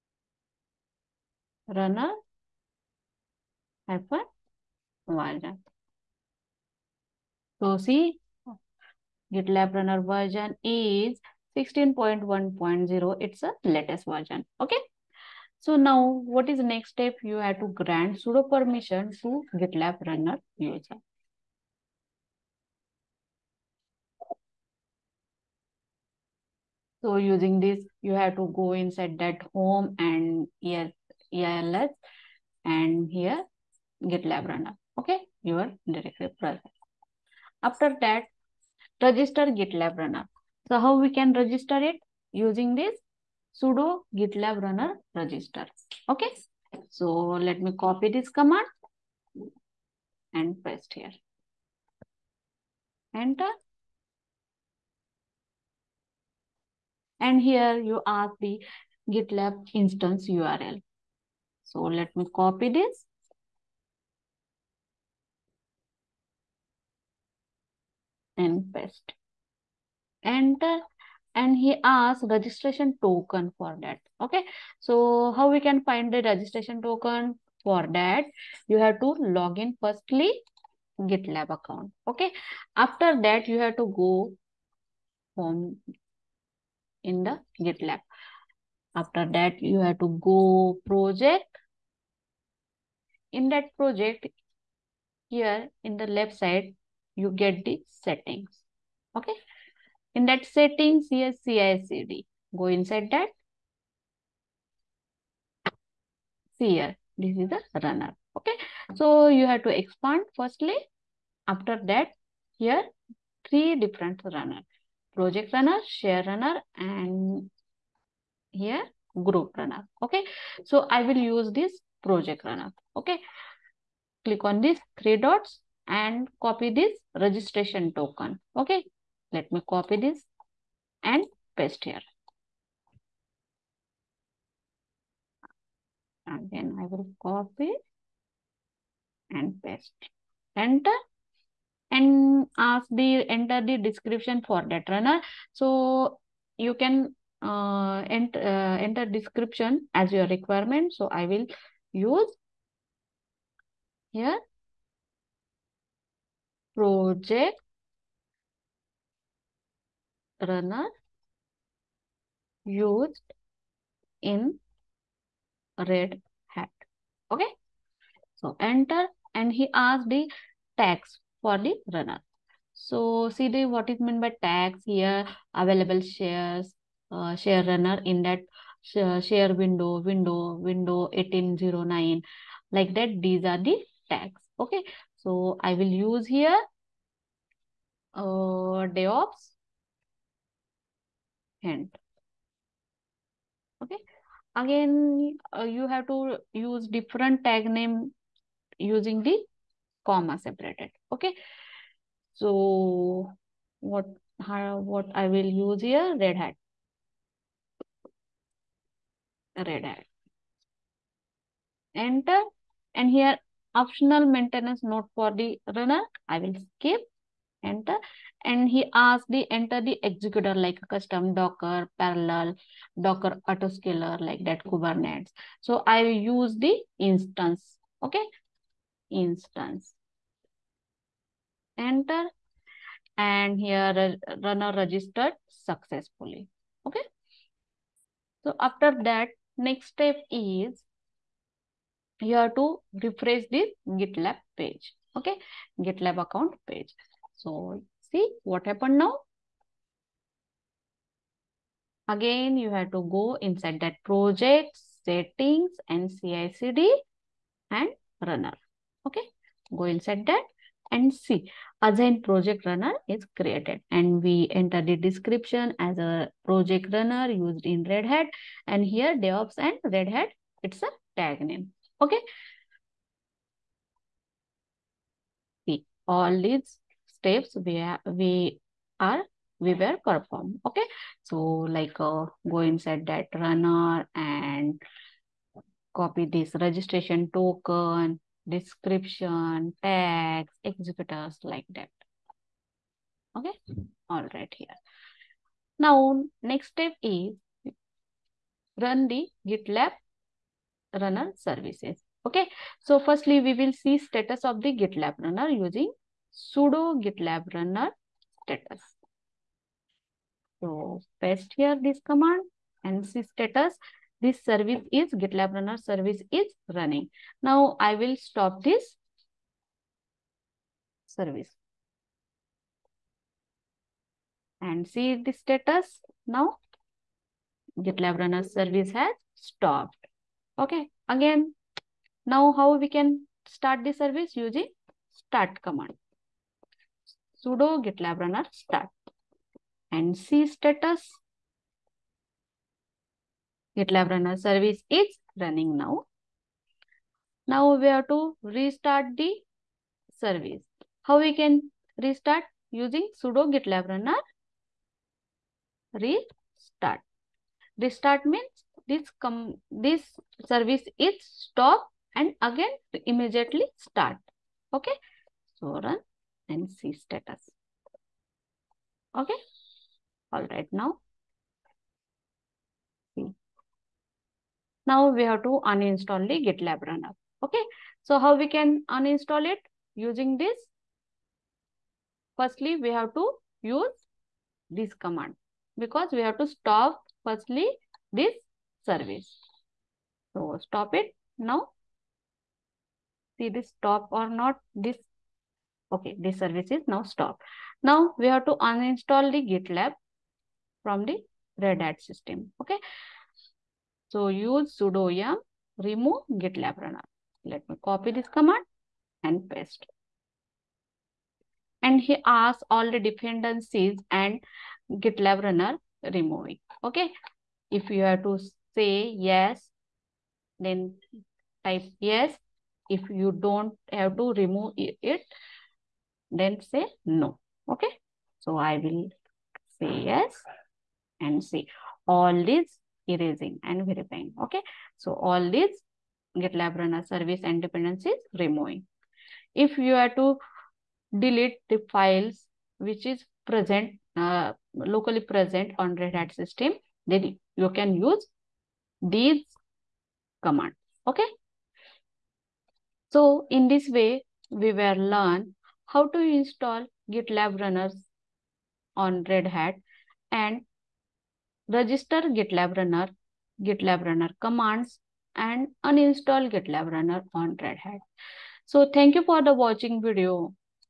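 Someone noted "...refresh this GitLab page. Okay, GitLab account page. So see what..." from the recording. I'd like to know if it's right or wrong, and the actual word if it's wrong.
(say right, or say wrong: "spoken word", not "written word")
right.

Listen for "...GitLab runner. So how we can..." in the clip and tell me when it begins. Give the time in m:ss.
0:39.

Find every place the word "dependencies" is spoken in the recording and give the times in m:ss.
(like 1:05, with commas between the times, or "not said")
6:52, 7:17.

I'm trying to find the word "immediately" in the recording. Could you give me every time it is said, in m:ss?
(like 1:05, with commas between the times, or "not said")
6:03.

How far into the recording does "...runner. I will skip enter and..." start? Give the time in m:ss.
3:35.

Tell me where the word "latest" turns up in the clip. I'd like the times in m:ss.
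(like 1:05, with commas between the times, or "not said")
0:13.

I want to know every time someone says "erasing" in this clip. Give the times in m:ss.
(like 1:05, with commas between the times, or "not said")
7:13.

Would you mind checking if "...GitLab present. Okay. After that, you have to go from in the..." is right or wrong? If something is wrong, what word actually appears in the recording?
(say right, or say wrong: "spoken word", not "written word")
wrong: "account", not "present".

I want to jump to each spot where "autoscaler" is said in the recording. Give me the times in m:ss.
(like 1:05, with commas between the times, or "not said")
3:43.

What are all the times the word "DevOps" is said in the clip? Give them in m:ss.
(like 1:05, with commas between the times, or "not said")
3:08, 4:29.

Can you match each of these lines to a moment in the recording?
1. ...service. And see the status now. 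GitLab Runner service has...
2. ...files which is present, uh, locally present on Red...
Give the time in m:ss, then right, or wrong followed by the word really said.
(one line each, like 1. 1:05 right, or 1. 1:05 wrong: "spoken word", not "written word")
1. 5:21 right
2. 7:21 right.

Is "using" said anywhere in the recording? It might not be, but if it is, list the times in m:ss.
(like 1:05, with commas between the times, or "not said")
0:27, 0:42, 3:18, 5:05, 5:34, 5:52, 6:19.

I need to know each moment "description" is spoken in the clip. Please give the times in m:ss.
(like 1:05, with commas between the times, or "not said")
2:23, 2:29, 4:24, 4:48.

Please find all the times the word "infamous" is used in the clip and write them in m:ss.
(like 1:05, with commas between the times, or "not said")
not said.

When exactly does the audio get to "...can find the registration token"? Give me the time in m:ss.
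1:15.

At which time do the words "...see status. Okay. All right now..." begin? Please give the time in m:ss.
6:06.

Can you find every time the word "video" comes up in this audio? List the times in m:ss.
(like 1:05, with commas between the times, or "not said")
7:50.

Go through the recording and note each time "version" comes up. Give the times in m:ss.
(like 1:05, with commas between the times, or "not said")
0:05, 0:10, 0:14.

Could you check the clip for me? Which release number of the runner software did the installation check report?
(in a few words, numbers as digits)
16.1.0.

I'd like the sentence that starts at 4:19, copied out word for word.
Okay, go inside that and C.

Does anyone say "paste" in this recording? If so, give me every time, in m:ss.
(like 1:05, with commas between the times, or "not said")
0:50, 1:08, 2:11, 2:19, 5:11, 6:49.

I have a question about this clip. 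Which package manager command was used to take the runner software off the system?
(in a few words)
yum remove.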